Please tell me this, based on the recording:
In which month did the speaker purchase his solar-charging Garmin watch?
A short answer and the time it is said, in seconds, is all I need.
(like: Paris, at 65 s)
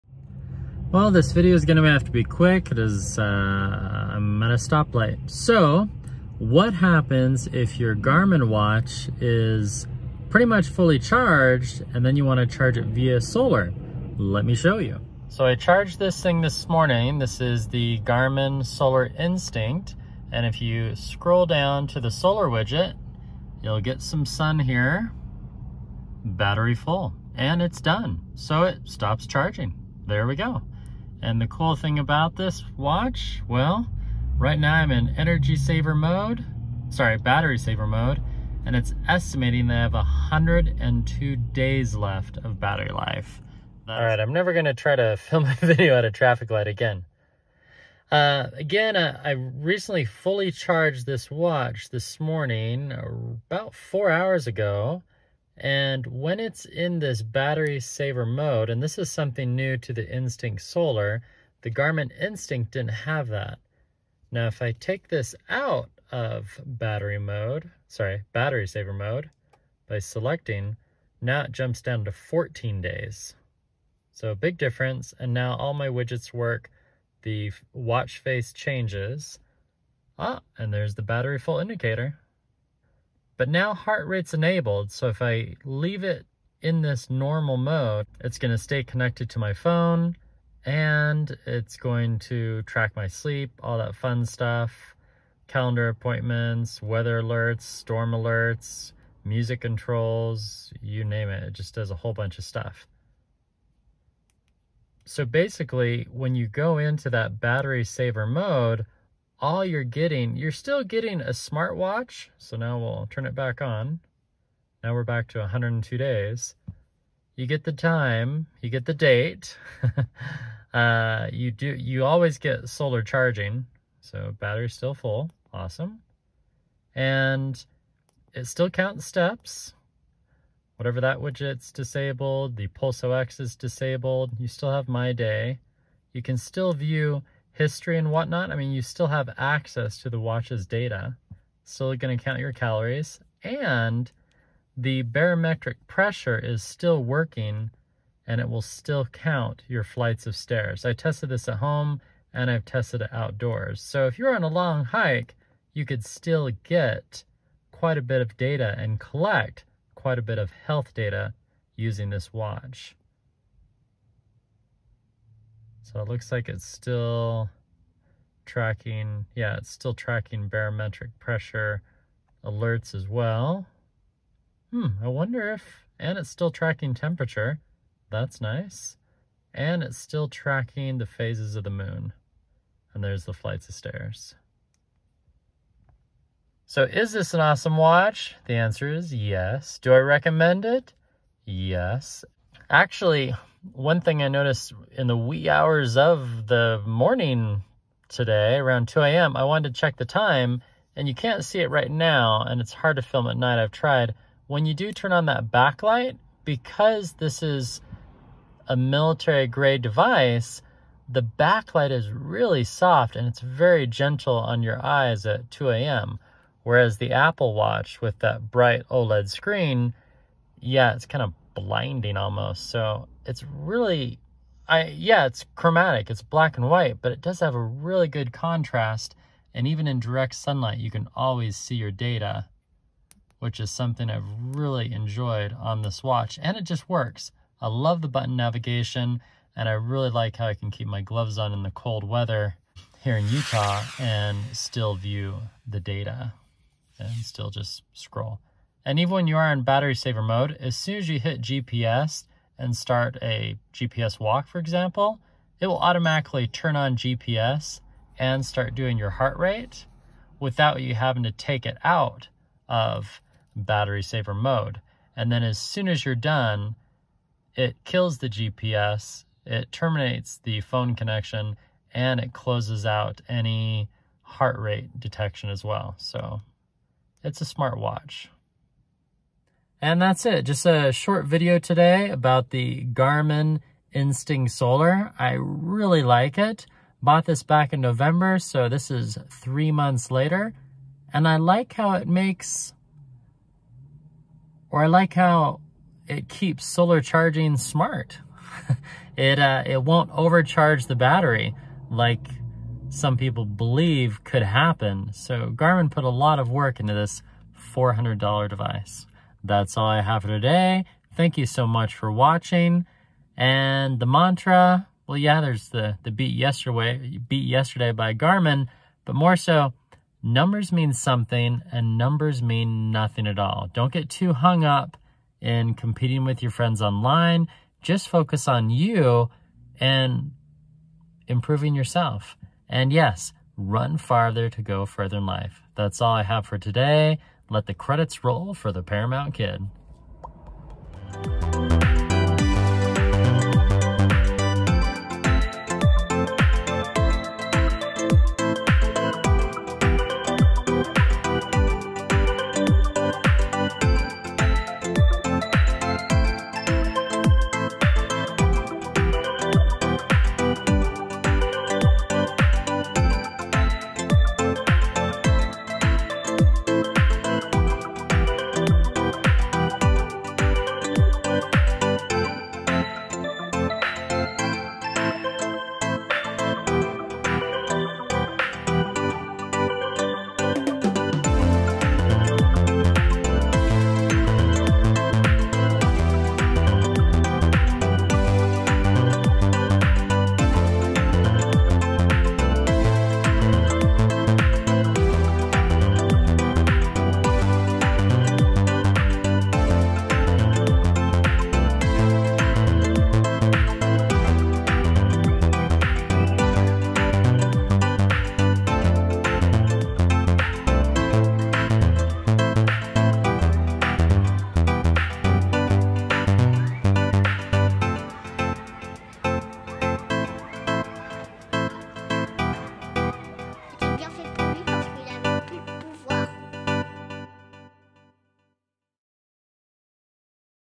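November, at 287 s.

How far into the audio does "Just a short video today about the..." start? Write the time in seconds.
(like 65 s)
280 s.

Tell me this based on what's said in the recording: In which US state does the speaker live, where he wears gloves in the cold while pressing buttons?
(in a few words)
Utah.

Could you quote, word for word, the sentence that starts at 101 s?
It just does a whole bunch of stuff.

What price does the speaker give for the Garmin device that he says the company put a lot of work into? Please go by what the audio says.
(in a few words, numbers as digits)
$400.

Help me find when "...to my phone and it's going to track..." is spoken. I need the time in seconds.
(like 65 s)
89 s.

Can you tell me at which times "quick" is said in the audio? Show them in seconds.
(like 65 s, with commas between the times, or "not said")
2 s.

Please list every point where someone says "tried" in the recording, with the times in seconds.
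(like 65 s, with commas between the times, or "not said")
203 s.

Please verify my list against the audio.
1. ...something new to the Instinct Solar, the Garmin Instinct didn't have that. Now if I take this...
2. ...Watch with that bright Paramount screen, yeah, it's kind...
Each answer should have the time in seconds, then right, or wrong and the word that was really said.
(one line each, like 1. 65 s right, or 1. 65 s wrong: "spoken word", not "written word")
1. 59 s right
2. 217 s wrong: "OLED", not "Paramount".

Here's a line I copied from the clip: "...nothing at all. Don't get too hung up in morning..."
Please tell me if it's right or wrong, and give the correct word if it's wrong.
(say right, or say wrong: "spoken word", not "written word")
wrong: "competing", not "morning".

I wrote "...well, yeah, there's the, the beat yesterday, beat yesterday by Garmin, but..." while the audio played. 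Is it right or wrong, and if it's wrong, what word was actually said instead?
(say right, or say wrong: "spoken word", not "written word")
right.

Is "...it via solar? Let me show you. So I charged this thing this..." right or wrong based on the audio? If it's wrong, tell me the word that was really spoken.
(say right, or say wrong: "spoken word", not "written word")
right.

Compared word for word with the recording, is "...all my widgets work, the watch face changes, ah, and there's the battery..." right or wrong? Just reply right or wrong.
right.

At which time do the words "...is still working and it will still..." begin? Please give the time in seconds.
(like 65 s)
146 s.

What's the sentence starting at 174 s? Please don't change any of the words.
Hmm, I wonder if, and it's still tracking temperature.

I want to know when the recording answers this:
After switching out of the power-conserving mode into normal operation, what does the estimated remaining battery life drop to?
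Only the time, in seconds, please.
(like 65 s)
72 s.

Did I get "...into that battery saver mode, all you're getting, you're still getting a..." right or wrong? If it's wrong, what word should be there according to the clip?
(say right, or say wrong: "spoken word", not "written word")
right.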